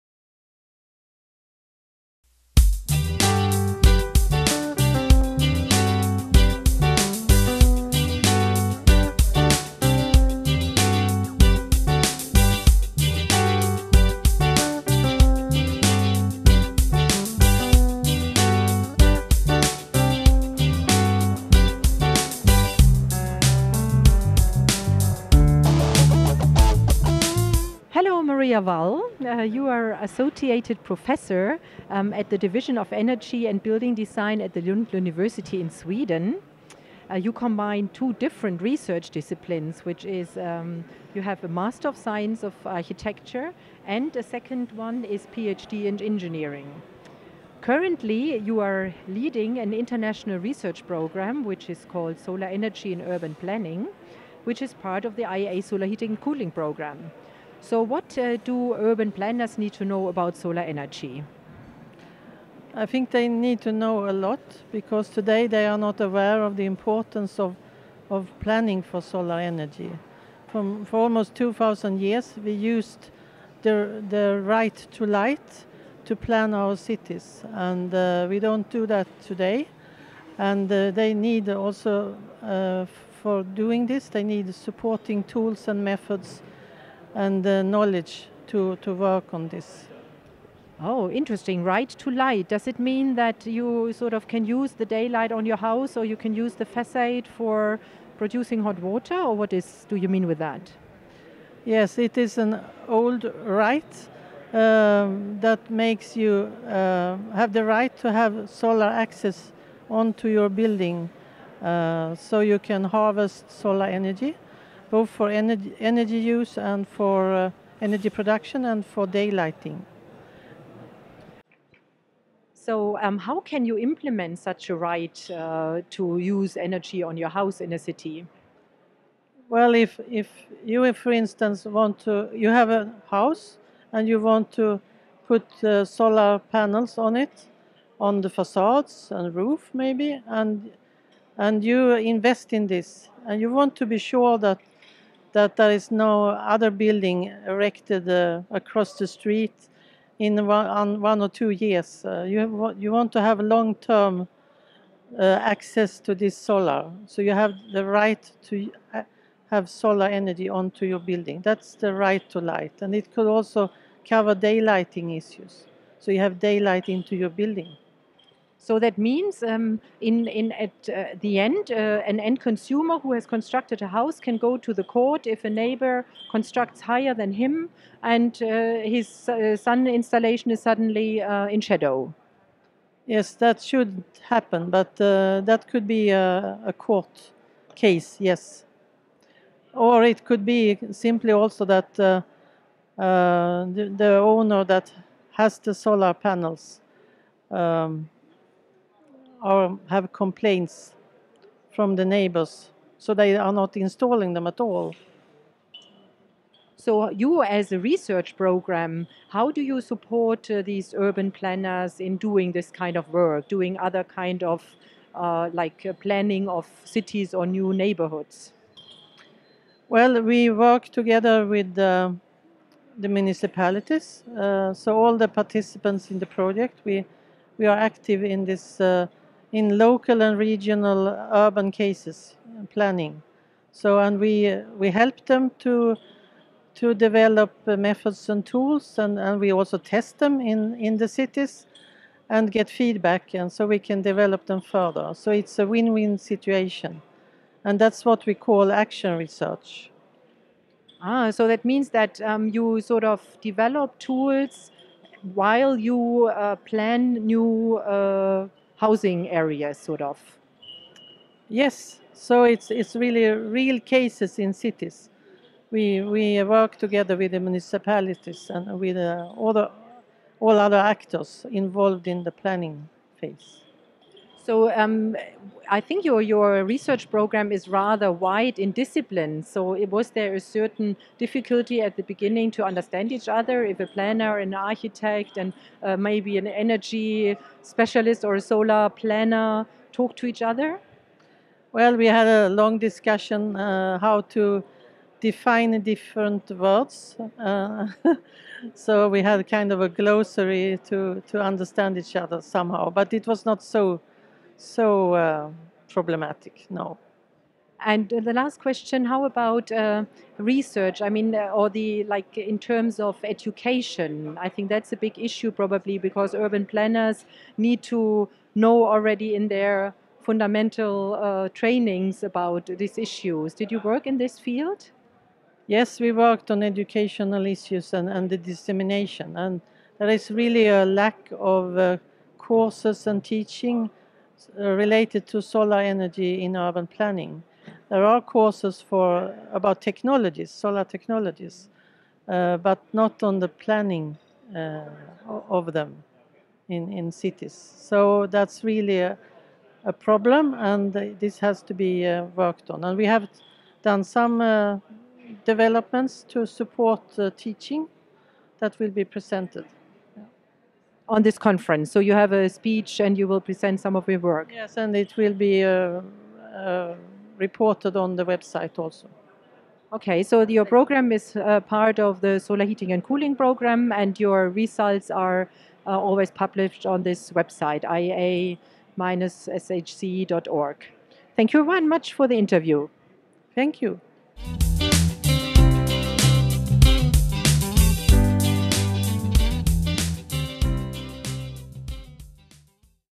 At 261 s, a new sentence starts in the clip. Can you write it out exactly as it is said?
Yes, so it's, it's really real cases in cities.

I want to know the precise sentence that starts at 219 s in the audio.
Well, we work together with the municipalities.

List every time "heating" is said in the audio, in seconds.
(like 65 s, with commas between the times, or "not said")
55 s, 372 s.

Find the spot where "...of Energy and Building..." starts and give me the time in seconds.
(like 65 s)
32 s.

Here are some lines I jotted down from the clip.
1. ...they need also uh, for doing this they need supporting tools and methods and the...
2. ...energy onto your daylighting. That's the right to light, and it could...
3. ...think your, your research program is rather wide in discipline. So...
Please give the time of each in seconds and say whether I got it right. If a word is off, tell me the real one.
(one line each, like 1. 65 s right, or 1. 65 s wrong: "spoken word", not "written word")
1. 80 s right
2. 160 s wrong: "building", not "daylighting"
3. 275 s right.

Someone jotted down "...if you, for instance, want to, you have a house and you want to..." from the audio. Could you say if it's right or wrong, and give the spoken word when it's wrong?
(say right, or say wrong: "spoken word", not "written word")
right.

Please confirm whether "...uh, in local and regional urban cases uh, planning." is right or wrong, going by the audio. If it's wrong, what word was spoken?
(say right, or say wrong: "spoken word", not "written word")
right.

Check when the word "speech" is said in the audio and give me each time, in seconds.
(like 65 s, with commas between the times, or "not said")
362 s.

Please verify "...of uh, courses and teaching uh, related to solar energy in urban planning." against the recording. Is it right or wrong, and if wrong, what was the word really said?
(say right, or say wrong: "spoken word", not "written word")
right.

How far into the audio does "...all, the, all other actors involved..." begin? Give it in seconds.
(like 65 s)
269 s.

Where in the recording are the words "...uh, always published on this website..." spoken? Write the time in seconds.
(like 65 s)
375 s.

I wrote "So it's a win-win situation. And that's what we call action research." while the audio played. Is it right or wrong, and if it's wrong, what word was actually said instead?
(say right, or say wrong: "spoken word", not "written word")
right.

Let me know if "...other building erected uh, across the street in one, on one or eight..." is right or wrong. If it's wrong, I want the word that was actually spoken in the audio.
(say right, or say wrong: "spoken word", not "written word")
wrong: "two", not "eight".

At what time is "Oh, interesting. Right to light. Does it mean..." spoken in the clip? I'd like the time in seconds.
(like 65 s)
90 s.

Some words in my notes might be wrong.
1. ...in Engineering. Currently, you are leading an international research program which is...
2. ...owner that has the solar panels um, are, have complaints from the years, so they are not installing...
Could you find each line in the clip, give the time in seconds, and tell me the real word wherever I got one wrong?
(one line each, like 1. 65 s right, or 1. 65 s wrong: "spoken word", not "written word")
1. 45 s right
2. 194 s wrong: "neighbors", not "years".